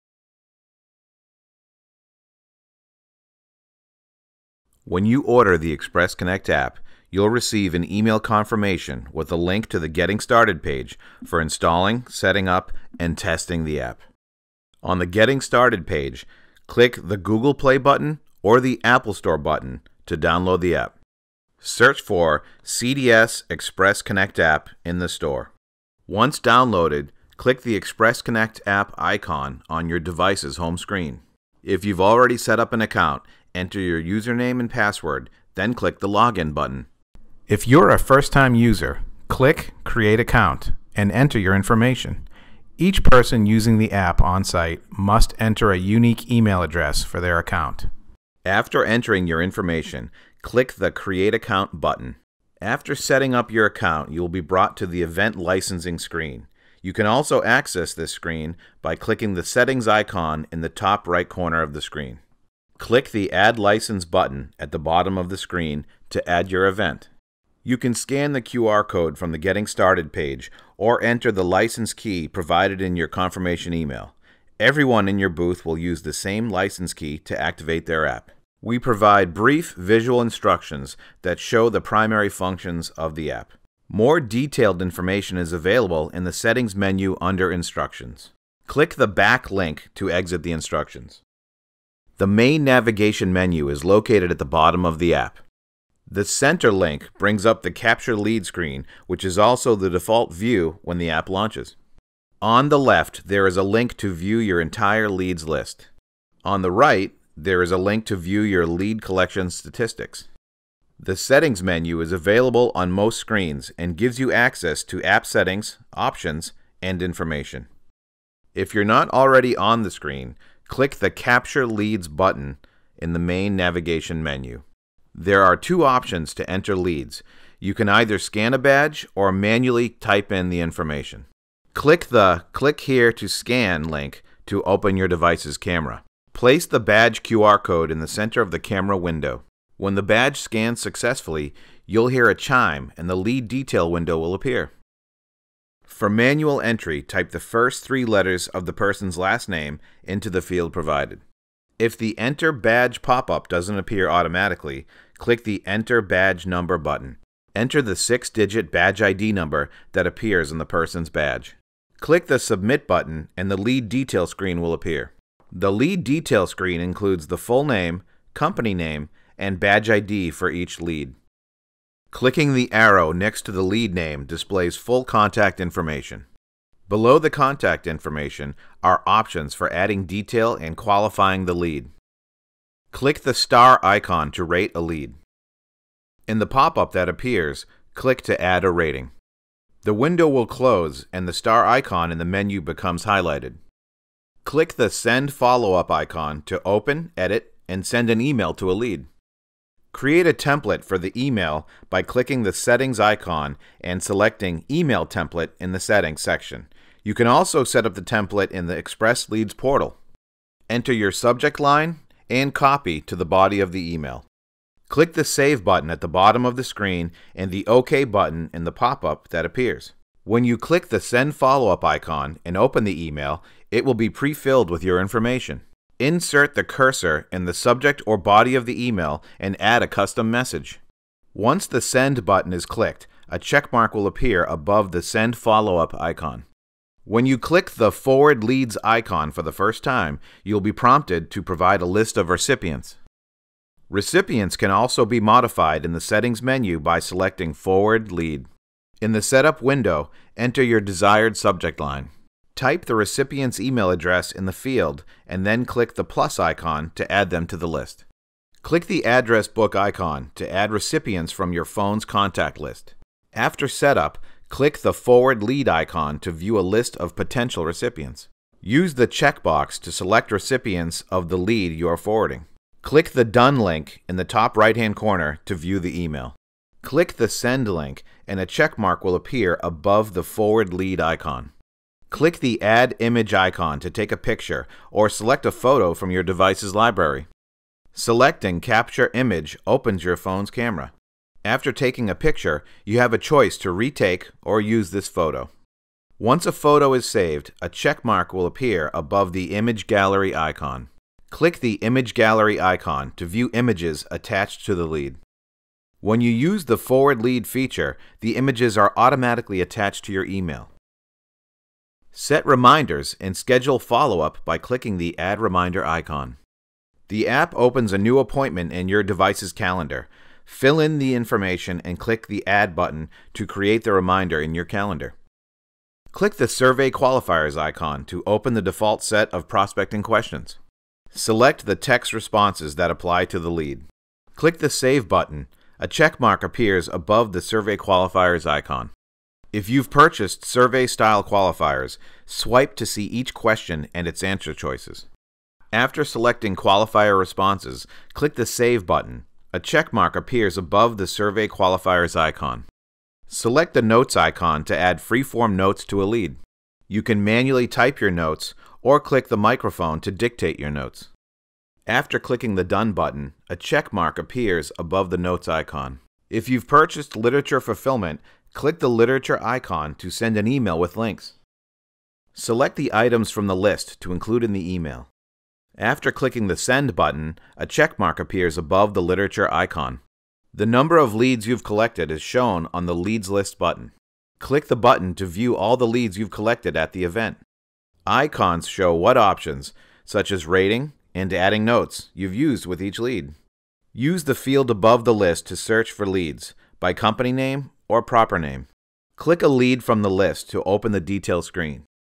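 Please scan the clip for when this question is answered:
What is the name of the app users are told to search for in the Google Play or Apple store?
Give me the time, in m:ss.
0:22.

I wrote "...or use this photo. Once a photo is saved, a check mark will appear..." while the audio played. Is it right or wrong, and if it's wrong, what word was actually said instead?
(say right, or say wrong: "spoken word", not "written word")
right.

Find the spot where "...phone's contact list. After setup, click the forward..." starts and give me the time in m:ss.
4:21.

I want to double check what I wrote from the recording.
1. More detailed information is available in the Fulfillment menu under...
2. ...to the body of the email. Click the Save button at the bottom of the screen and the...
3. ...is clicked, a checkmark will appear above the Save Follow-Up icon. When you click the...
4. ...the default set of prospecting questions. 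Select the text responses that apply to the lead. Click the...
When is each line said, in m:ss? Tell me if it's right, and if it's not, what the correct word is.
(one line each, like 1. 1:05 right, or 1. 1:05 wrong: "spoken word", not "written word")
1. 1:23 wrong: "Settings", not "Fulfillment"
2. 3:33 right
3. 3:52 wrong: "Send", not "Save"
4. 5:28 right.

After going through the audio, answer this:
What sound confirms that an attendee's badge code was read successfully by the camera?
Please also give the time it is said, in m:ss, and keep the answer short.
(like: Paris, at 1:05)
A chime, at 2:22.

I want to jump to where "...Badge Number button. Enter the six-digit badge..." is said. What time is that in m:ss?
2:36.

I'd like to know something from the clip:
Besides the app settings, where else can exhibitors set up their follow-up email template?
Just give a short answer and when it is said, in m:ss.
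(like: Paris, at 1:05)
Express Leads portal, at 3:28.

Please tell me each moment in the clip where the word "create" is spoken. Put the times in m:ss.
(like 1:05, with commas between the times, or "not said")
0:39, 0:50, 3:19, 5:23.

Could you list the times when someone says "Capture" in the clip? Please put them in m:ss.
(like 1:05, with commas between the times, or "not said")
1:37, 2:01, 4:48.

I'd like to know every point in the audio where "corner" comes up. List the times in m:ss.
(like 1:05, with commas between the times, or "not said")
1:01, 4:34.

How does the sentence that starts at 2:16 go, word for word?
Place the badge QR code in the center of the camera window.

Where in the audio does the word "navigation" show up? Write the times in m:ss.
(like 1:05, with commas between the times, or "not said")
1:32, 2:03.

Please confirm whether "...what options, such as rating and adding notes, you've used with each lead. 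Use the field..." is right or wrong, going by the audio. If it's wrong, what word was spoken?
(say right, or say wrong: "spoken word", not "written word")
right.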